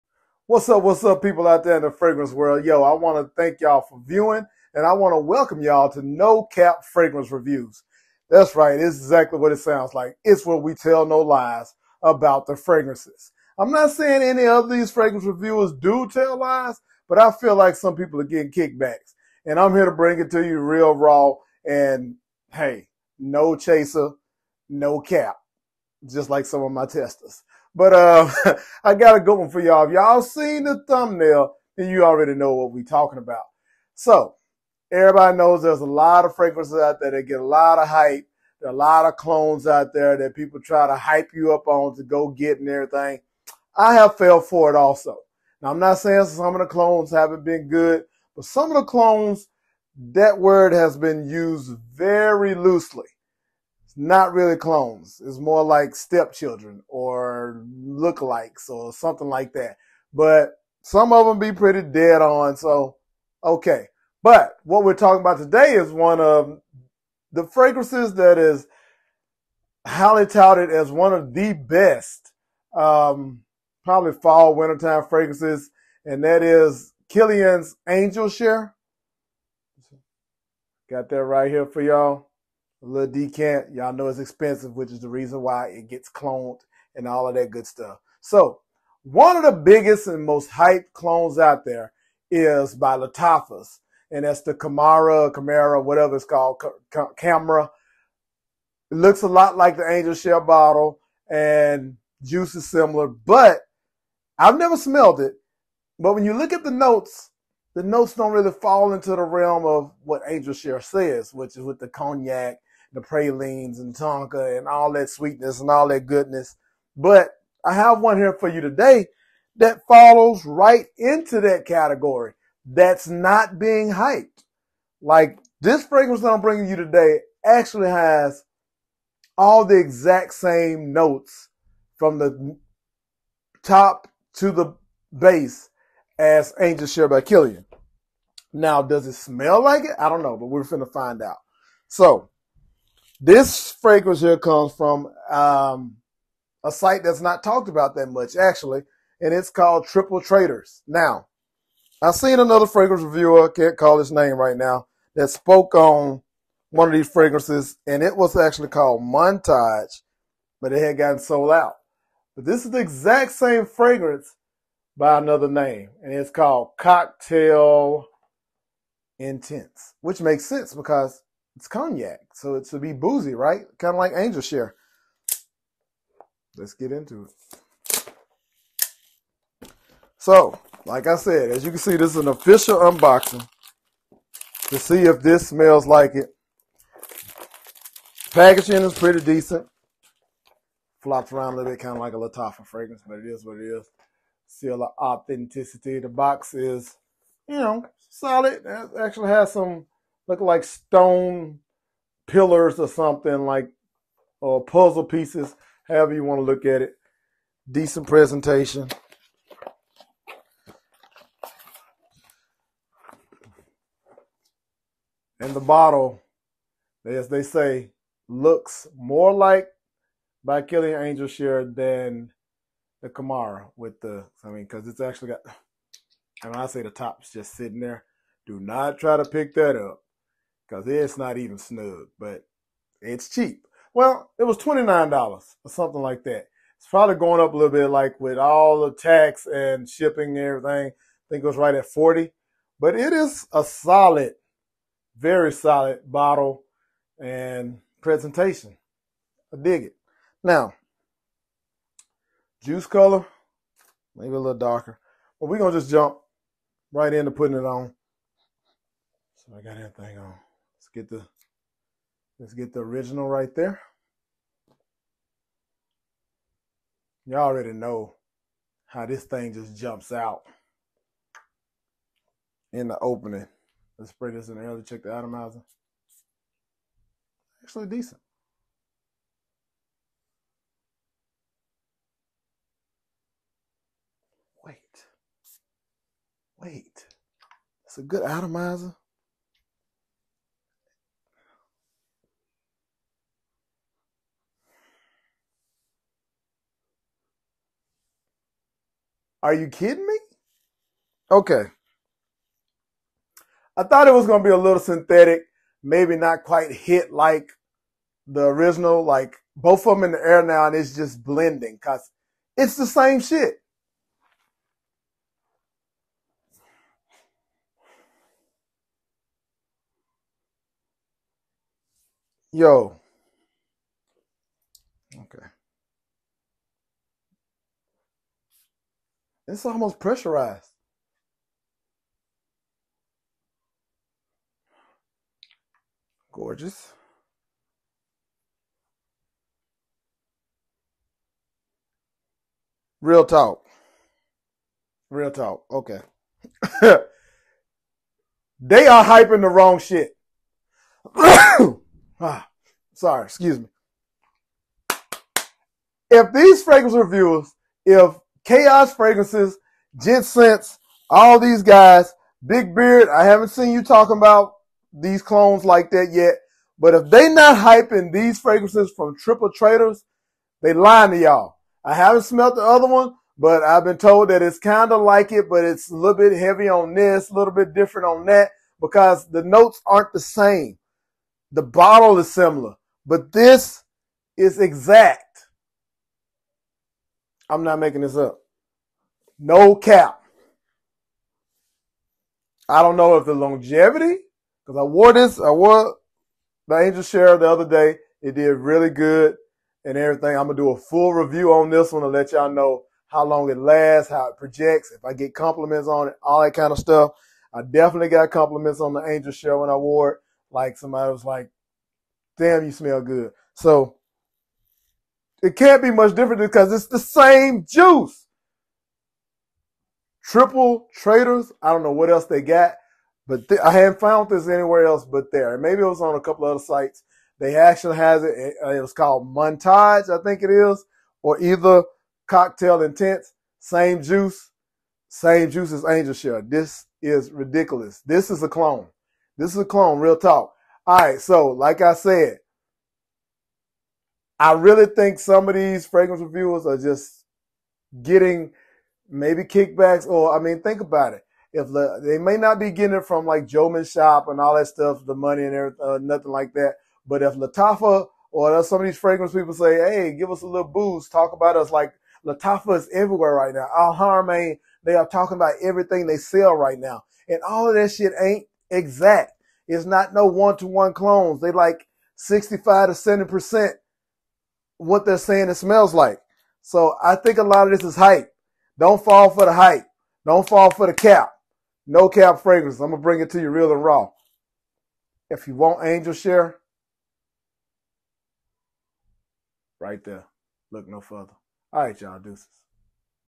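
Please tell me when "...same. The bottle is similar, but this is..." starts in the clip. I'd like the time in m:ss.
6:20.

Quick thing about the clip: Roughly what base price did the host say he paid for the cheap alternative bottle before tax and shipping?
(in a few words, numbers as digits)
$29.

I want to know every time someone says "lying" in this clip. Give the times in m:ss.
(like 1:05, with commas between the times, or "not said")
6:10.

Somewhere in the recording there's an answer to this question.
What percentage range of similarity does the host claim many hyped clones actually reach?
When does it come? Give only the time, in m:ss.
7:52.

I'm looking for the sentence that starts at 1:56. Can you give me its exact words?
But I have one here for you today that follows right into that category that's not being hyped.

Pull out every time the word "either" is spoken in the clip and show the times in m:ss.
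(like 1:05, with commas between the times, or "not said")
7:11.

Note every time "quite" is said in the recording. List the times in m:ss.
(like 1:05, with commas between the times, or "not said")
5:06.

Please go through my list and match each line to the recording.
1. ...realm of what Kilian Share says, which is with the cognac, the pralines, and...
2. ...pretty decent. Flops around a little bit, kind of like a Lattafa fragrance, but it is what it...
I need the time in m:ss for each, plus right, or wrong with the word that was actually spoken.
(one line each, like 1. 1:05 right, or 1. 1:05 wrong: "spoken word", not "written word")
1. 1:49 wrong: "Angel", not "Kilian"
2. 3:08 right.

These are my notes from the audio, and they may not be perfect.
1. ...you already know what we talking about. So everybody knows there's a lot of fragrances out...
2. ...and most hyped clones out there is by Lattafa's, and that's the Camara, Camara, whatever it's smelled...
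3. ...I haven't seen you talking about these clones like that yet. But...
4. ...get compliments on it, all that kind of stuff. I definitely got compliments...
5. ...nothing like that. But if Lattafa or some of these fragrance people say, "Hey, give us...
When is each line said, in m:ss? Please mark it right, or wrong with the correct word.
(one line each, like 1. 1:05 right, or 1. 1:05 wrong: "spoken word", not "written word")
1. 0:31 right
2. 1:30 wrong: "called", not "smelled"
3. 6:03 right
4. 6:45 right
5. 7:35 right.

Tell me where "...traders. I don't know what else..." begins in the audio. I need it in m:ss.
7:00.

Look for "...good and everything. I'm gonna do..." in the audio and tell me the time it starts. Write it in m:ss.
6:38.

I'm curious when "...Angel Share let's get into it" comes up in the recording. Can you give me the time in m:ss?
2:54.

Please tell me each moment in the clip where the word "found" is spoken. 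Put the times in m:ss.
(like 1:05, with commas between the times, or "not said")
7:03.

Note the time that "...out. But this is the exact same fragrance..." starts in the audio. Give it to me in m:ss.
2:41.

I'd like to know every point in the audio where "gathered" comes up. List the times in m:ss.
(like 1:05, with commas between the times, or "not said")
not said.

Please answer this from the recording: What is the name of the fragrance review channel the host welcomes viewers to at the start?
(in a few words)
No Cap Fragrance Reviews.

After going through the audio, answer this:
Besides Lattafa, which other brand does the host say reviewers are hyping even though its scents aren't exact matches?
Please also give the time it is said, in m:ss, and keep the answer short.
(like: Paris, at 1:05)
Al Haramain, at 7:43.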